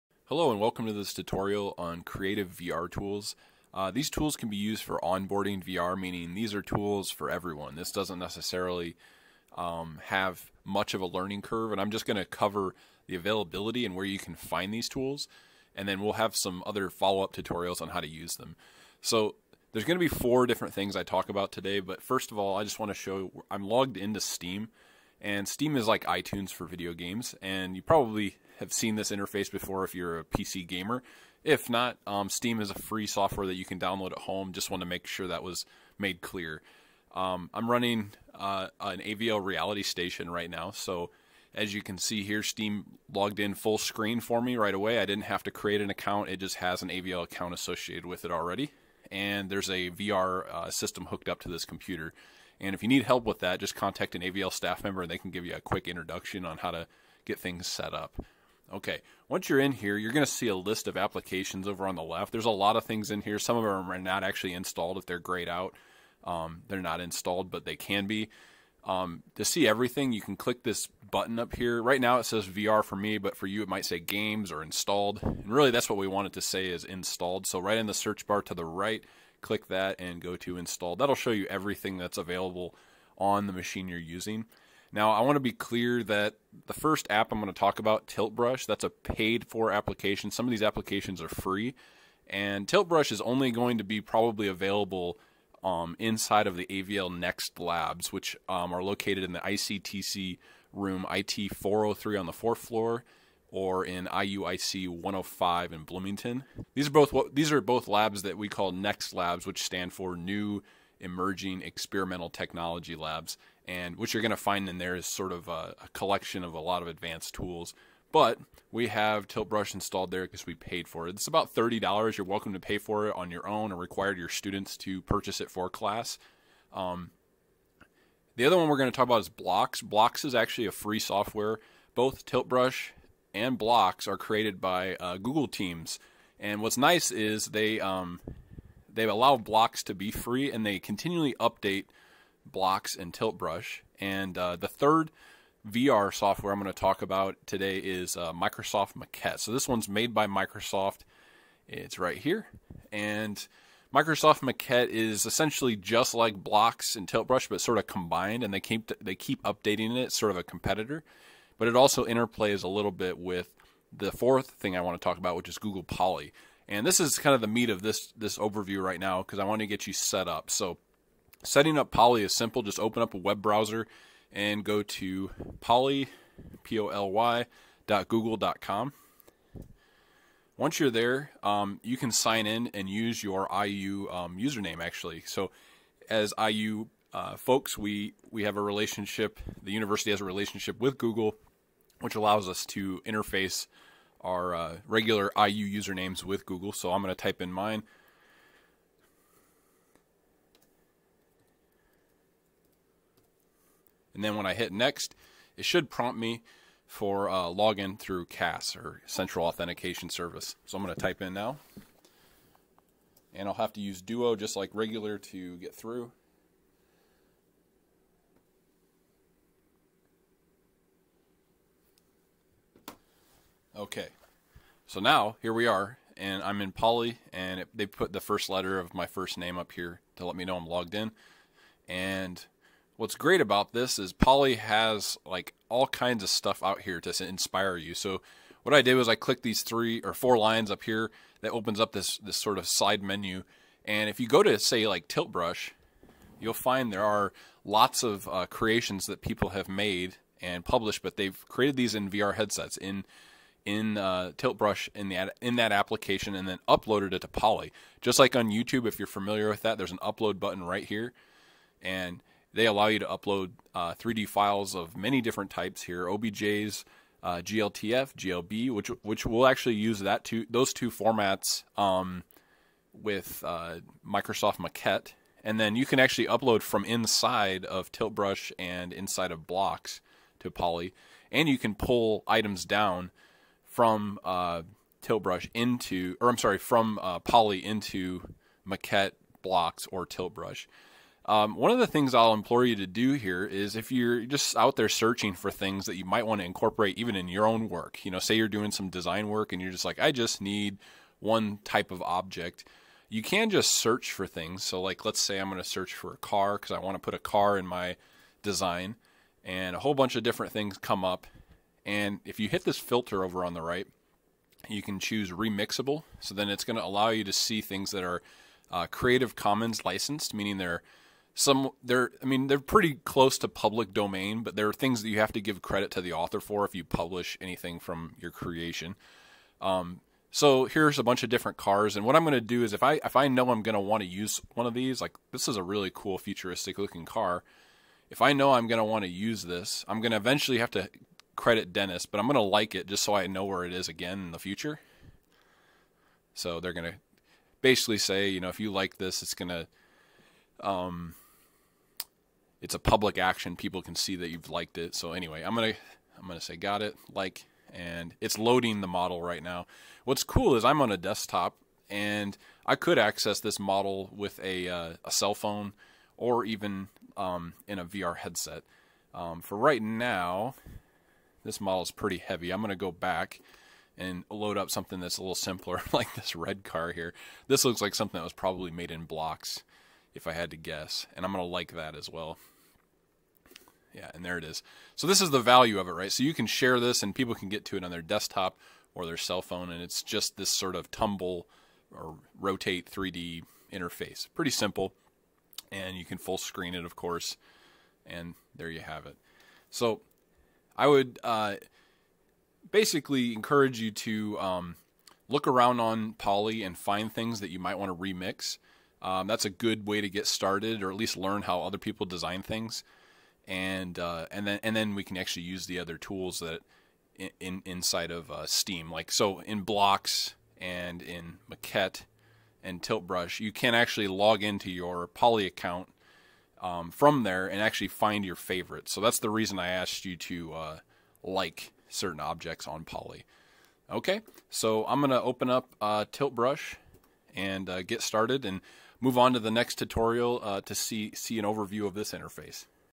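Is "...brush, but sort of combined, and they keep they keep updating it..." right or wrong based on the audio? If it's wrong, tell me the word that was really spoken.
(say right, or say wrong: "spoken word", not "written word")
right.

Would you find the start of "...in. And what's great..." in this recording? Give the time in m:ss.
3:50.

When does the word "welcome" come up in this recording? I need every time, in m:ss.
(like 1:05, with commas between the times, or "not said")
0:00, 2:02.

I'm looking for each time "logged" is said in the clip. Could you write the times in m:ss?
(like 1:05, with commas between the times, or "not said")
0:23, 0:43, 3:50.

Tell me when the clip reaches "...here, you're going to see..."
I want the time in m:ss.
0:59.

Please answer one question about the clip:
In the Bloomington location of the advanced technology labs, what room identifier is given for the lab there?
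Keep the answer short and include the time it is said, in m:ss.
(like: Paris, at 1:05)
IUIC 105, at 1:44.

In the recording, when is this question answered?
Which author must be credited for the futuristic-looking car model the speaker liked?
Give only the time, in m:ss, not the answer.
5:41.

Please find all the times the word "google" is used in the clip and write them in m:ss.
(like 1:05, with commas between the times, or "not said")
2:15, 2:45, 2:58, 3:10, 3:16.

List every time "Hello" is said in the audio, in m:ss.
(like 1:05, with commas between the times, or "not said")
0:00.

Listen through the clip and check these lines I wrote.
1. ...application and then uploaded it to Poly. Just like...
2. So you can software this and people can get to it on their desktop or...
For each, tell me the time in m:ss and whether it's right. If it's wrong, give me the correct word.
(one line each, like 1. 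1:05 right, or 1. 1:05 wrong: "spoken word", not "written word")
1. 4:15 right
2. 6:26 wrong: "share", not "software".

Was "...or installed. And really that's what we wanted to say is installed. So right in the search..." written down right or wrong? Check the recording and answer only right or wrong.
right.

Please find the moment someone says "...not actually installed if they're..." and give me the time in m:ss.
1:03.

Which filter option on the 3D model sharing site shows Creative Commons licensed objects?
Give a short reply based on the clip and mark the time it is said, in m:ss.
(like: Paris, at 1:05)
remixable, at 5:15.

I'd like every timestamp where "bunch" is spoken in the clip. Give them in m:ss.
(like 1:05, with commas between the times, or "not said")
5:09, 5:31.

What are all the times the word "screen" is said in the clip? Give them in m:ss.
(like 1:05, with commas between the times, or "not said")
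0:43, 6:36.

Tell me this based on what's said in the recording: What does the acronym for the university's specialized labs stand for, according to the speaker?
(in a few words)
New Emerging Experimental Technology Labs.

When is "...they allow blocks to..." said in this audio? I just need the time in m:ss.
2:18.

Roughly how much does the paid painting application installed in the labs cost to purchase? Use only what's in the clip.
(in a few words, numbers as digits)
$30.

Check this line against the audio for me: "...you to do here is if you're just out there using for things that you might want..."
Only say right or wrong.
wrong.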